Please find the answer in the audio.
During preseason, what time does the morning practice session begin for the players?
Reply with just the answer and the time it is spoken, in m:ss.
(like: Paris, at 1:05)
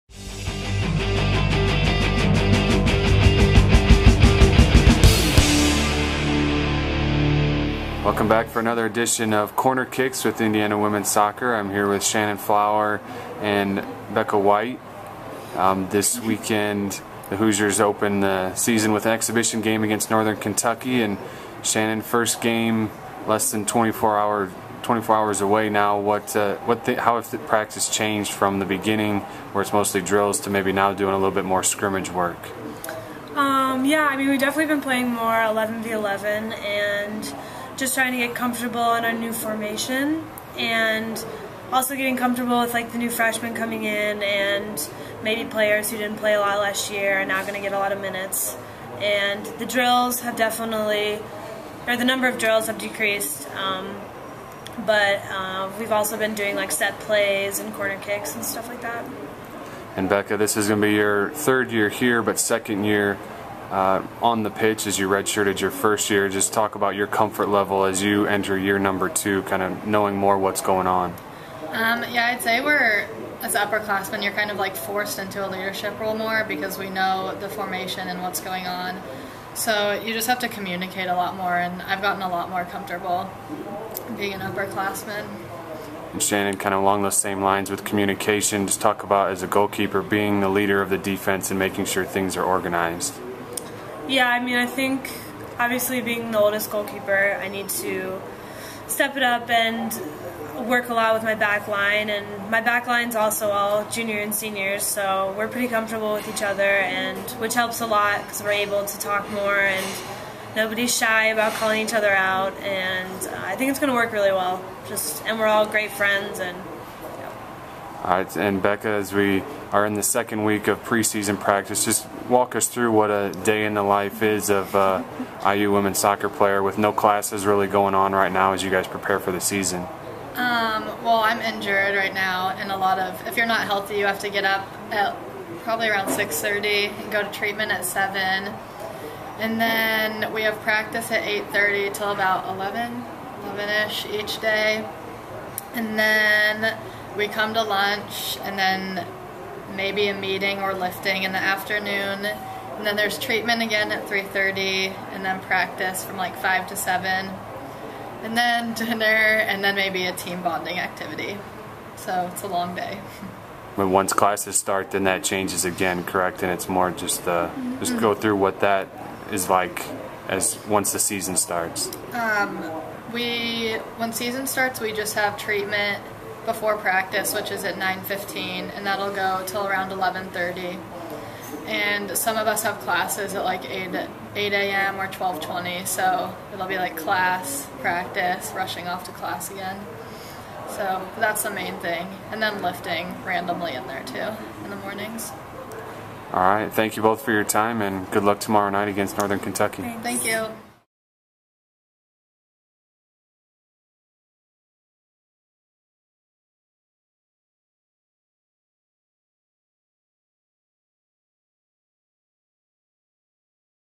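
8:30, at 2:21.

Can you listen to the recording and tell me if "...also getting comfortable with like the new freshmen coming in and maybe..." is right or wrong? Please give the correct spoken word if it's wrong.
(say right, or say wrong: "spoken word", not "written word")
right.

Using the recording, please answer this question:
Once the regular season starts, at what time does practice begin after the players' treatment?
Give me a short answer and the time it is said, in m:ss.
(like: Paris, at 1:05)
9:15, at 2:57.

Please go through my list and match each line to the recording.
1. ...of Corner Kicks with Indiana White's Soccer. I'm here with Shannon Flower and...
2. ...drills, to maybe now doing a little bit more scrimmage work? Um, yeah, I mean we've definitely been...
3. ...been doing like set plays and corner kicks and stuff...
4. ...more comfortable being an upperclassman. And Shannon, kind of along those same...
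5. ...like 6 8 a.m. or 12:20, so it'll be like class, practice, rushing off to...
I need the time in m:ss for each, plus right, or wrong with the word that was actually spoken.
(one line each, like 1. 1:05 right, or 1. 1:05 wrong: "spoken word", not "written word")
1. 0:09 wrong: "Women", not "White"
2. 0:30 right
3. 0:56 right
4. 1:22 right
5. 3:03 wrong: "8", not "6".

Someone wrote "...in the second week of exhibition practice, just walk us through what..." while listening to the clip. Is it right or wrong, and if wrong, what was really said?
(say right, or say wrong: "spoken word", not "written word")
wrong: "preseason", not "exhibition".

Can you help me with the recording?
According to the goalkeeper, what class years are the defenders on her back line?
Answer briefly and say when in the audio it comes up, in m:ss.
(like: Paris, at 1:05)
Junior and seniors, at 1:43.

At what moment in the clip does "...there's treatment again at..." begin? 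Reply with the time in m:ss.
2:32.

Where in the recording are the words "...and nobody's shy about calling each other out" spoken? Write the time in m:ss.
1:49.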